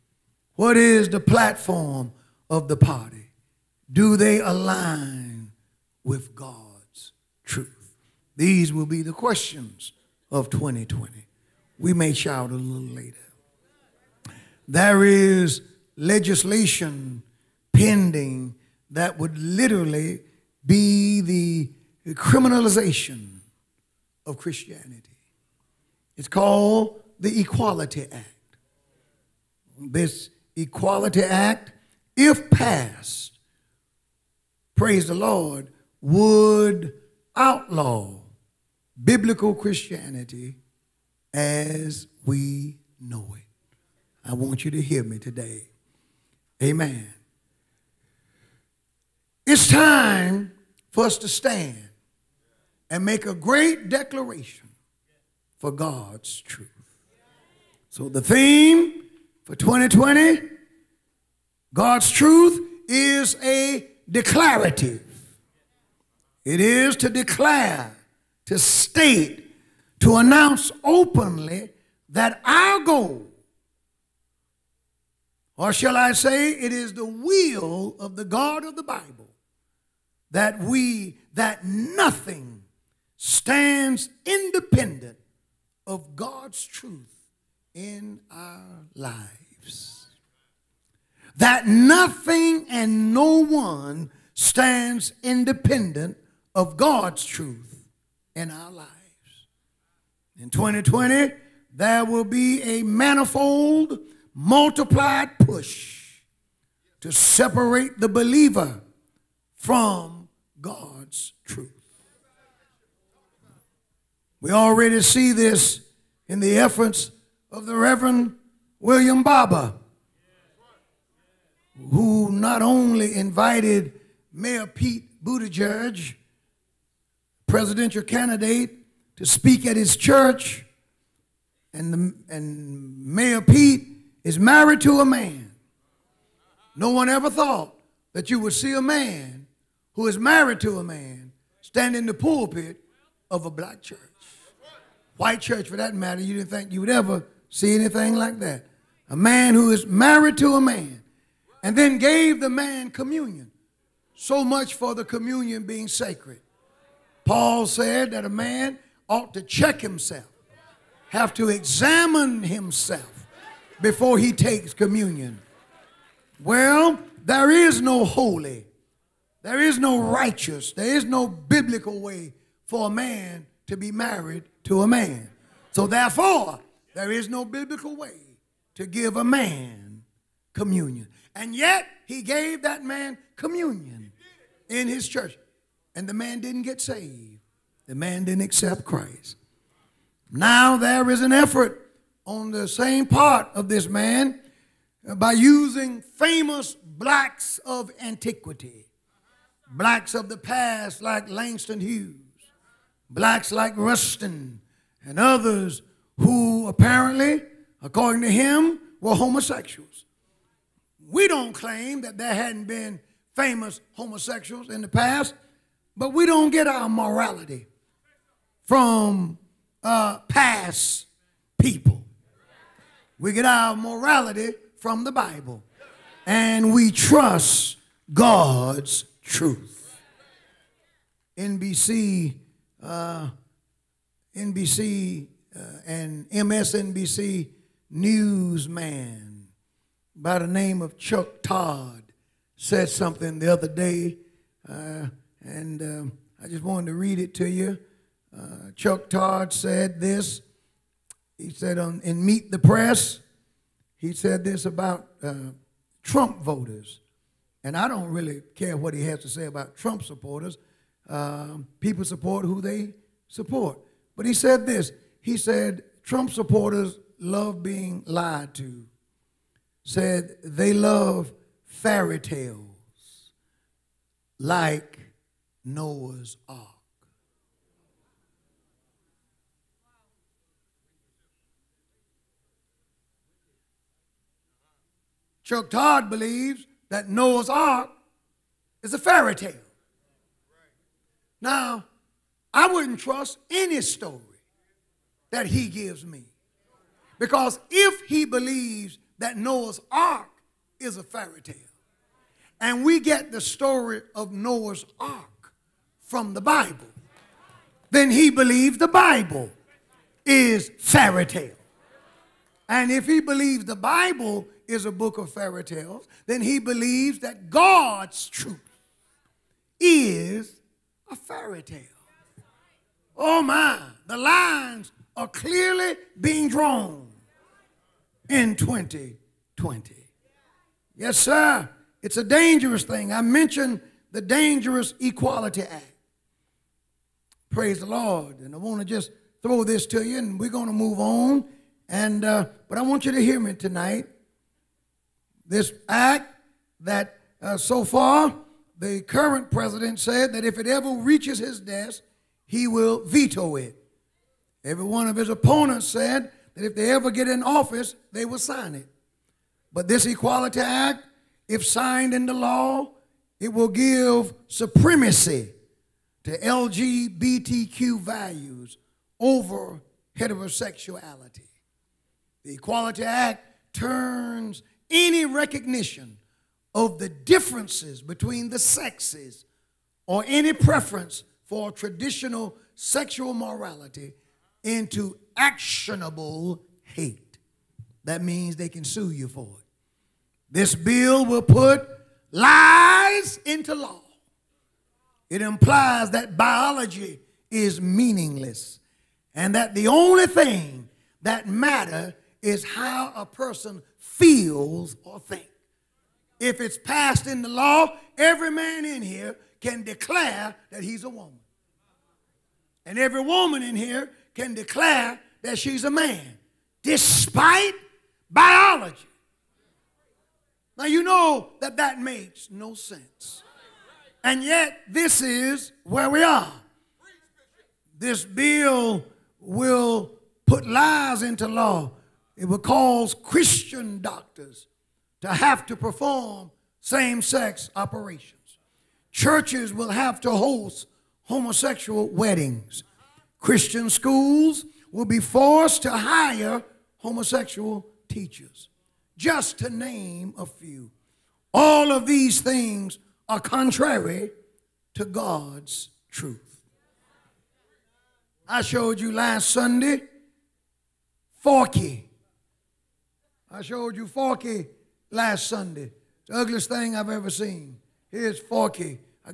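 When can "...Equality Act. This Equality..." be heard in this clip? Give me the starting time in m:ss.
0:27.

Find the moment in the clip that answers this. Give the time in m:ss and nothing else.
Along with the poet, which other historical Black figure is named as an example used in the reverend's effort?
3:23.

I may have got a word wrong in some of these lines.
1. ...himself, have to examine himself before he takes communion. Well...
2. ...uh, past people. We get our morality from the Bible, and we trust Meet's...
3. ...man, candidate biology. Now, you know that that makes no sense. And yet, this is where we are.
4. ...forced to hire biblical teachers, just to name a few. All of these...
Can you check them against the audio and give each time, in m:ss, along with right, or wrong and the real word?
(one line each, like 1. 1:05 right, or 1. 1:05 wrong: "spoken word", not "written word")
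1. 2:39 right
2. 3:39 wrong: "God", not "Meet"
3. 6:55 wrong: "despite", not "candidate"
4. 7:25 wrong: "homosexual", not "biblical".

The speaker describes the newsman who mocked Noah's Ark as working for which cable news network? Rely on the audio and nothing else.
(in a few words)
MSNBC.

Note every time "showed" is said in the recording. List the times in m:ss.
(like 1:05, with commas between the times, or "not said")
7:38, 7:43.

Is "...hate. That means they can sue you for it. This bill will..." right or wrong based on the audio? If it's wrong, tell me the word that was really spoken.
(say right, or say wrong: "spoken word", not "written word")
right.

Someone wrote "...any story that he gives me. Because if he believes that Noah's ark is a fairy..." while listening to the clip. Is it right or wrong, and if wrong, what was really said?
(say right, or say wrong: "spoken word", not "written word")
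right.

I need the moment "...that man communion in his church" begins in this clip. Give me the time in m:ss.
3:02.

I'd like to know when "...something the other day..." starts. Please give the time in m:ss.
4:02.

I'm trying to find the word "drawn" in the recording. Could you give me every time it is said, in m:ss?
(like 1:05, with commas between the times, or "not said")
5:26.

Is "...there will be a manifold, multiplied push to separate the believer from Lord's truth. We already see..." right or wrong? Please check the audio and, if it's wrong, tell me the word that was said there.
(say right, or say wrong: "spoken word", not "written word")
wrong: "God", not "Lord".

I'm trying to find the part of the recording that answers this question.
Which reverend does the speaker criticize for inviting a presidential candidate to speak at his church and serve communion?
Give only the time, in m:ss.
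1:58.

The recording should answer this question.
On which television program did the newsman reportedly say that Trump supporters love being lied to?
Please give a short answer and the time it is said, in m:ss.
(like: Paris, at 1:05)
Meet the Press, at 4:12.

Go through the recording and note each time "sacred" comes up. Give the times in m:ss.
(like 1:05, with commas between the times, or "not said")
2:35.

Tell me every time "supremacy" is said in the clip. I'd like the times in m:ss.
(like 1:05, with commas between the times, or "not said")
6:04.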